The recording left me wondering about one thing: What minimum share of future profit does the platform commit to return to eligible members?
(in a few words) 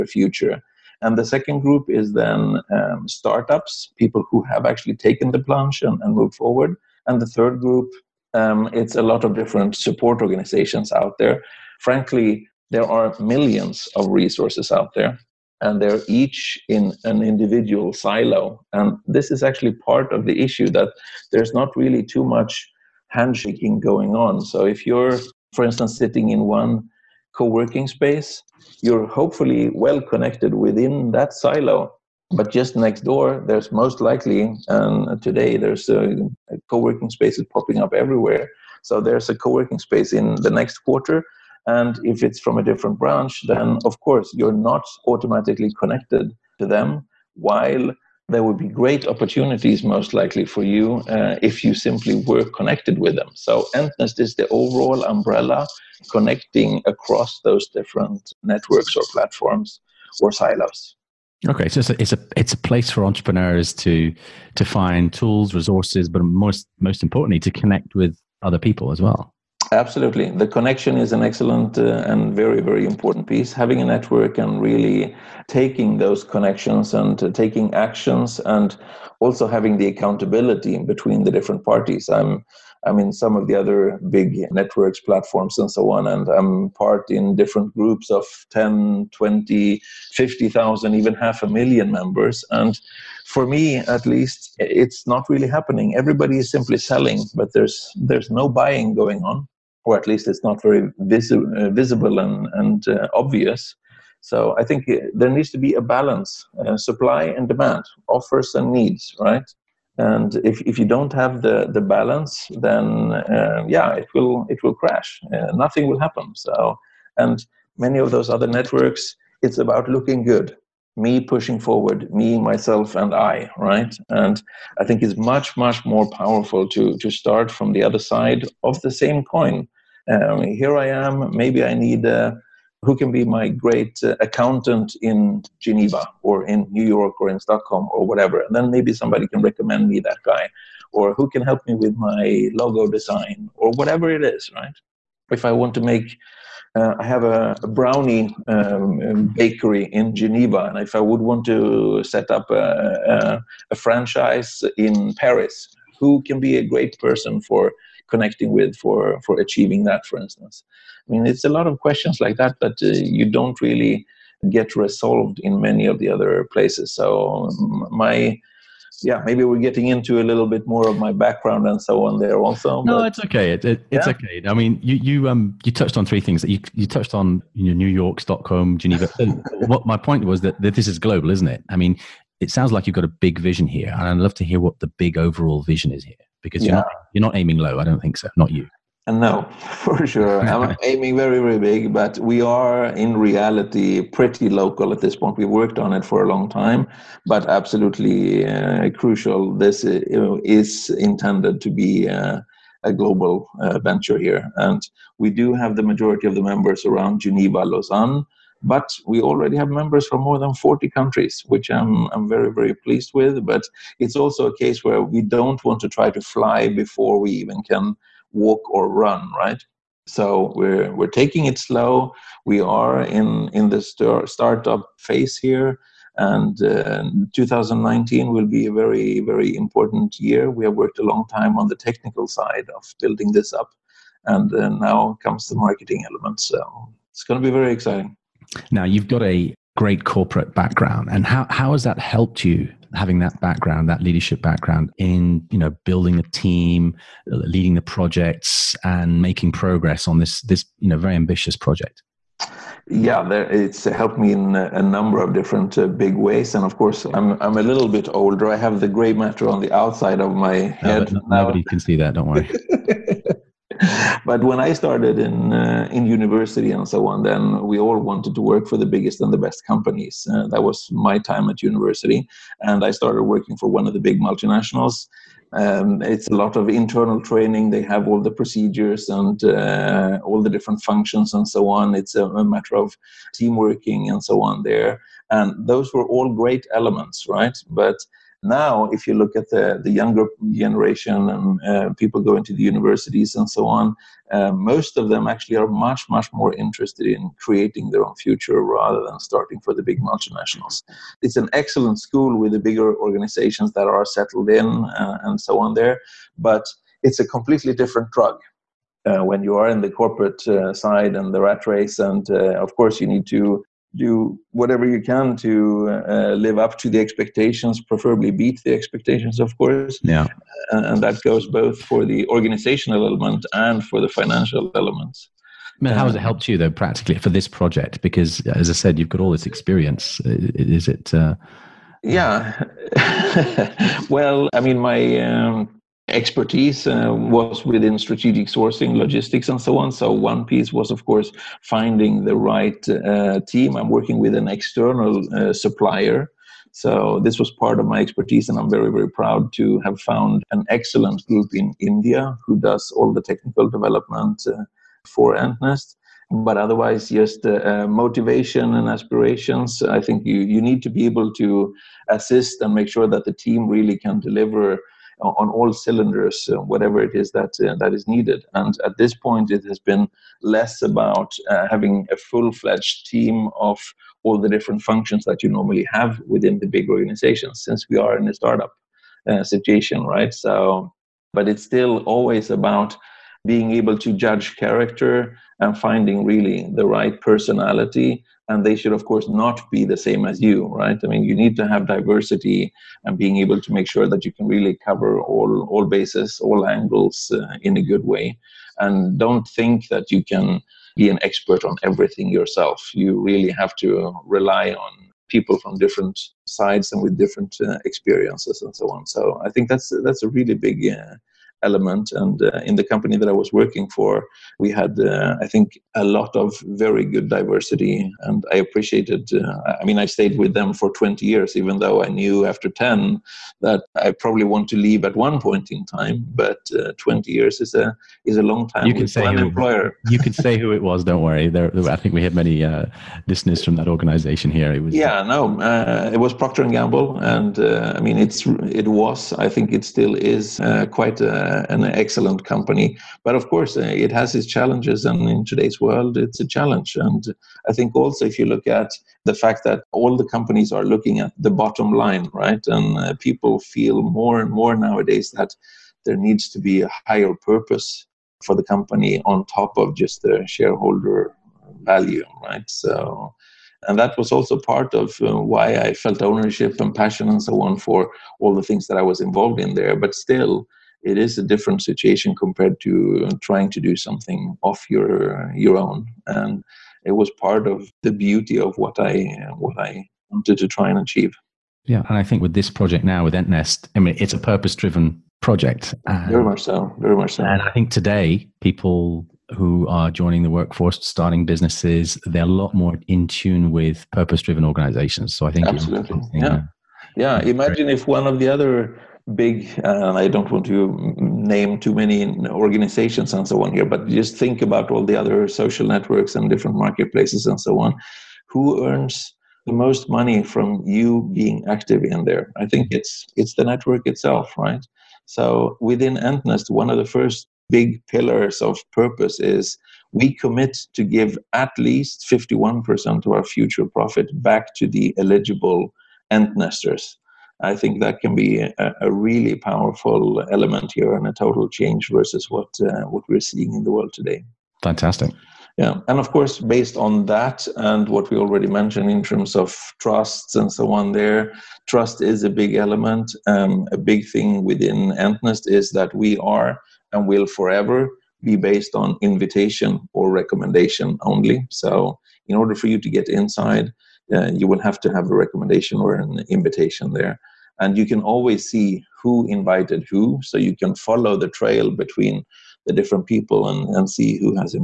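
51%.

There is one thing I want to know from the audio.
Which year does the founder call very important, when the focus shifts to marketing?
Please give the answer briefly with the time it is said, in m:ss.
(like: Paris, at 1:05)
2019, at 3:47.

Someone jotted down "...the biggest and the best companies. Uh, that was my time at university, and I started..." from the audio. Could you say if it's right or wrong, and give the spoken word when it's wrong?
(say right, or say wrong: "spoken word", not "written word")
right.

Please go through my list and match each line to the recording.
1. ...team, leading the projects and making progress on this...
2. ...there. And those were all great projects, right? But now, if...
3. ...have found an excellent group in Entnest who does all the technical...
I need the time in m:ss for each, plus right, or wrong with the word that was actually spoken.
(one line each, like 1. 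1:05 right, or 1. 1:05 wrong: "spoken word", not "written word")
1. 4:06 right
2. 4:44 wrong: "elements", not "projects"
3. 5:49 wrong: "India", not "Entnest".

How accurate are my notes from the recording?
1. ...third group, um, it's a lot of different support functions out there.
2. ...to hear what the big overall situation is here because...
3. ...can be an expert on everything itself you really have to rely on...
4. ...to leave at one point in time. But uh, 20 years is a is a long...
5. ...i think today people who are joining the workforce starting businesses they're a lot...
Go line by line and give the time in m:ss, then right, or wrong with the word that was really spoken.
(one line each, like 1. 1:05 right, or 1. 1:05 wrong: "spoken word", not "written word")
1. 0:07 wrong: "organizations", not "functions"
2. 3:04 wrong: "vision", not "situation"
3. 6:40 wrong: "yourself", not "itself"
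4. 7:04 right
5. 8:07 right.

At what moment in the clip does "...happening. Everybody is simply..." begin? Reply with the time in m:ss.
1:35.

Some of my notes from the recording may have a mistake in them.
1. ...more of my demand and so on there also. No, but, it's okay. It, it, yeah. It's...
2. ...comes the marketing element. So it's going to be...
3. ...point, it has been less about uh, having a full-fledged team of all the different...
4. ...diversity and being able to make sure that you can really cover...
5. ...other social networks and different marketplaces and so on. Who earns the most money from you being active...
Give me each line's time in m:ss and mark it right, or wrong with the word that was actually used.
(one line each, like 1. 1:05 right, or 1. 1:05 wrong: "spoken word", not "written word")
1. 2:50 wrong: "background", not "demand"
2. 3:55 right
3. 6:09 right
4. 6:31 right
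5. 8:25 right.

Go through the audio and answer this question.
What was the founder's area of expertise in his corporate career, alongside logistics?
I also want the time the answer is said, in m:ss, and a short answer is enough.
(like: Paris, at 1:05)
Strategic sourcing, at 5:37.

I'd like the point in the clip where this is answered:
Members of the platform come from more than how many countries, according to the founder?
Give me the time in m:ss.
3:30.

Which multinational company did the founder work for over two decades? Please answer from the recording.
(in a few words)
Procter and Gamble.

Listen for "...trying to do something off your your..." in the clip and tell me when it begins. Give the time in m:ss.
7:53.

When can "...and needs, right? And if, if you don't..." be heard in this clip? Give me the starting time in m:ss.
1:48.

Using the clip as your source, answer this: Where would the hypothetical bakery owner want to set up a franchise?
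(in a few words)
Paris.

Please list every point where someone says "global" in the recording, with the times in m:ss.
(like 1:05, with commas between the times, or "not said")
3:00, 3:22.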